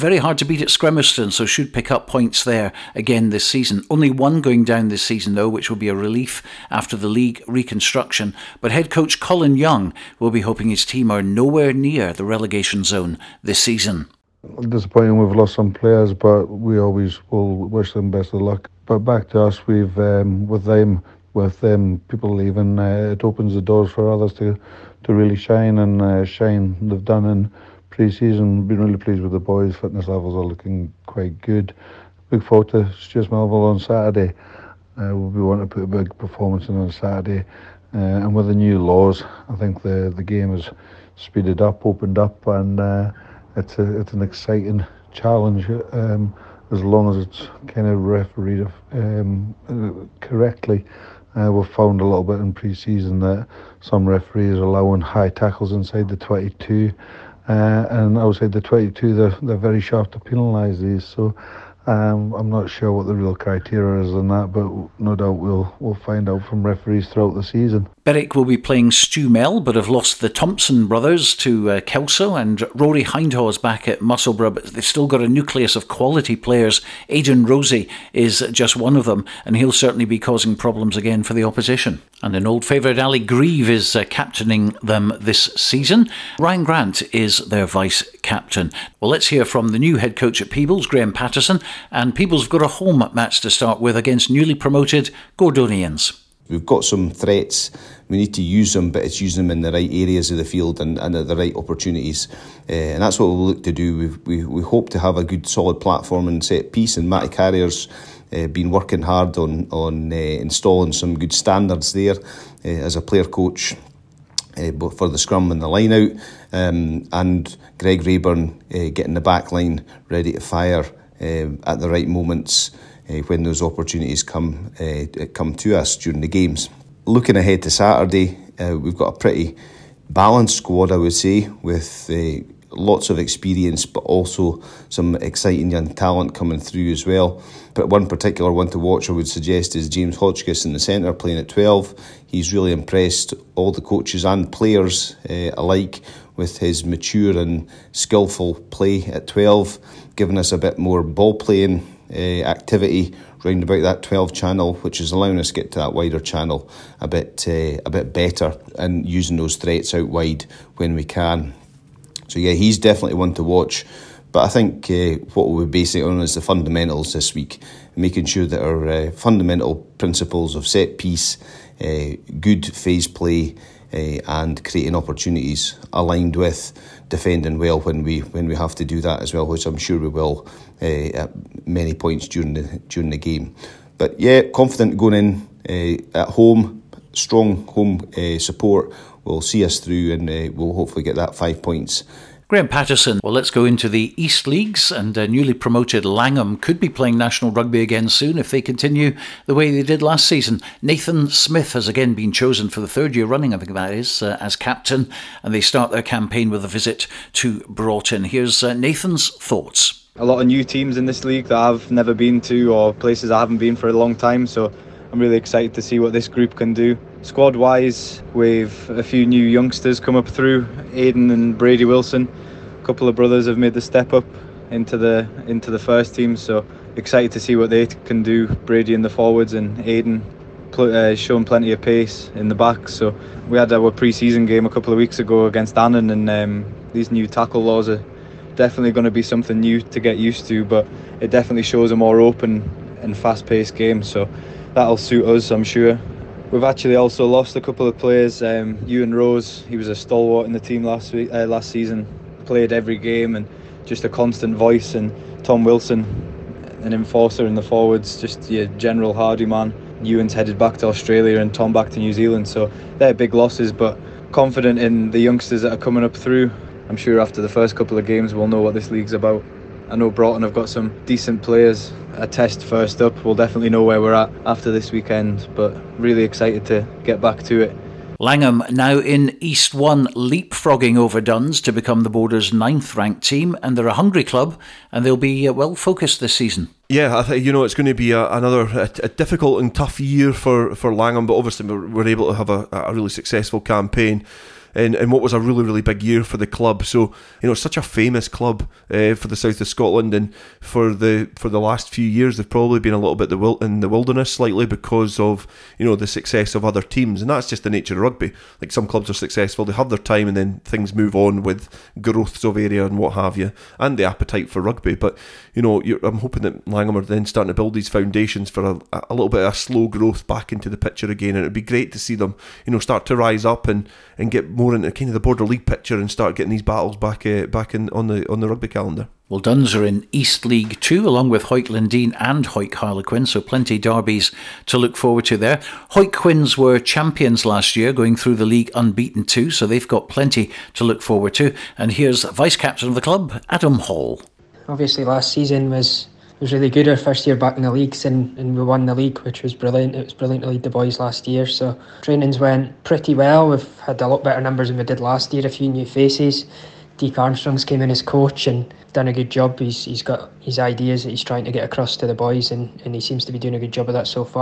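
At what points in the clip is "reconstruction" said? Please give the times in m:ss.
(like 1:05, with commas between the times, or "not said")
0:07.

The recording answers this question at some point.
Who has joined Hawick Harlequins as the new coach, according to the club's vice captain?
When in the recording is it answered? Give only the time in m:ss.
5:56.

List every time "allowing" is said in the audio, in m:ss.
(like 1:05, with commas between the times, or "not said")
0:54, 2:35.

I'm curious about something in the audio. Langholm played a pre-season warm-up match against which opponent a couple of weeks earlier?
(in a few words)
Annan.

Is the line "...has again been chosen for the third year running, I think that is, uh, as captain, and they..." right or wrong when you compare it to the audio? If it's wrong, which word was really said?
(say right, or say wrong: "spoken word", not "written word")
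right.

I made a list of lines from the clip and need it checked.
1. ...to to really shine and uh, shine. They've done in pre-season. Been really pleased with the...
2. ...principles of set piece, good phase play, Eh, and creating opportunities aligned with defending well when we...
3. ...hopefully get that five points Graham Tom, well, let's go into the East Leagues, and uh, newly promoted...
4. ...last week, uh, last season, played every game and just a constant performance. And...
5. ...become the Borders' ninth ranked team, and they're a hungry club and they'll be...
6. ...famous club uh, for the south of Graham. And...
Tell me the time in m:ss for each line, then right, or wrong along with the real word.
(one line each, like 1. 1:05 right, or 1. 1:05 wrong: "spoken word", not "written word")
1. 0:24 right
2. 2:49 right
3. 3:10 wrong: "Patterson", not "Tom"
4. 4:10 wrong: "voice", not "performance"
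5. 4:41 right
6. 4:57 wrong: "Scotland", not "Graham".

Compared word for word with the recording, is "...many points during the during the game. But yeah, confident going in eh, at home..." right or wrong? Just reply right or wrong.
right.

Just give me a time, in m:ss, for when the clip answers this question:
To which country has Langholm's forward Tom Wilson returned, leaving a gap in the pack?
4:22.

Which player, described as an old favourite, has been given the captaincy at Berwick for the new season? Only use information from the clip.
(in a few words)
Ali Grieve.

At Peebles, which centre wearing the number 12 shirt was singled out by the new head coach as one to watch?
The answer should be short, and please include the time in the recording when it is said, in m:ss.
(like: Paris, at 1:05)
James Hotchkiss, at 2:19.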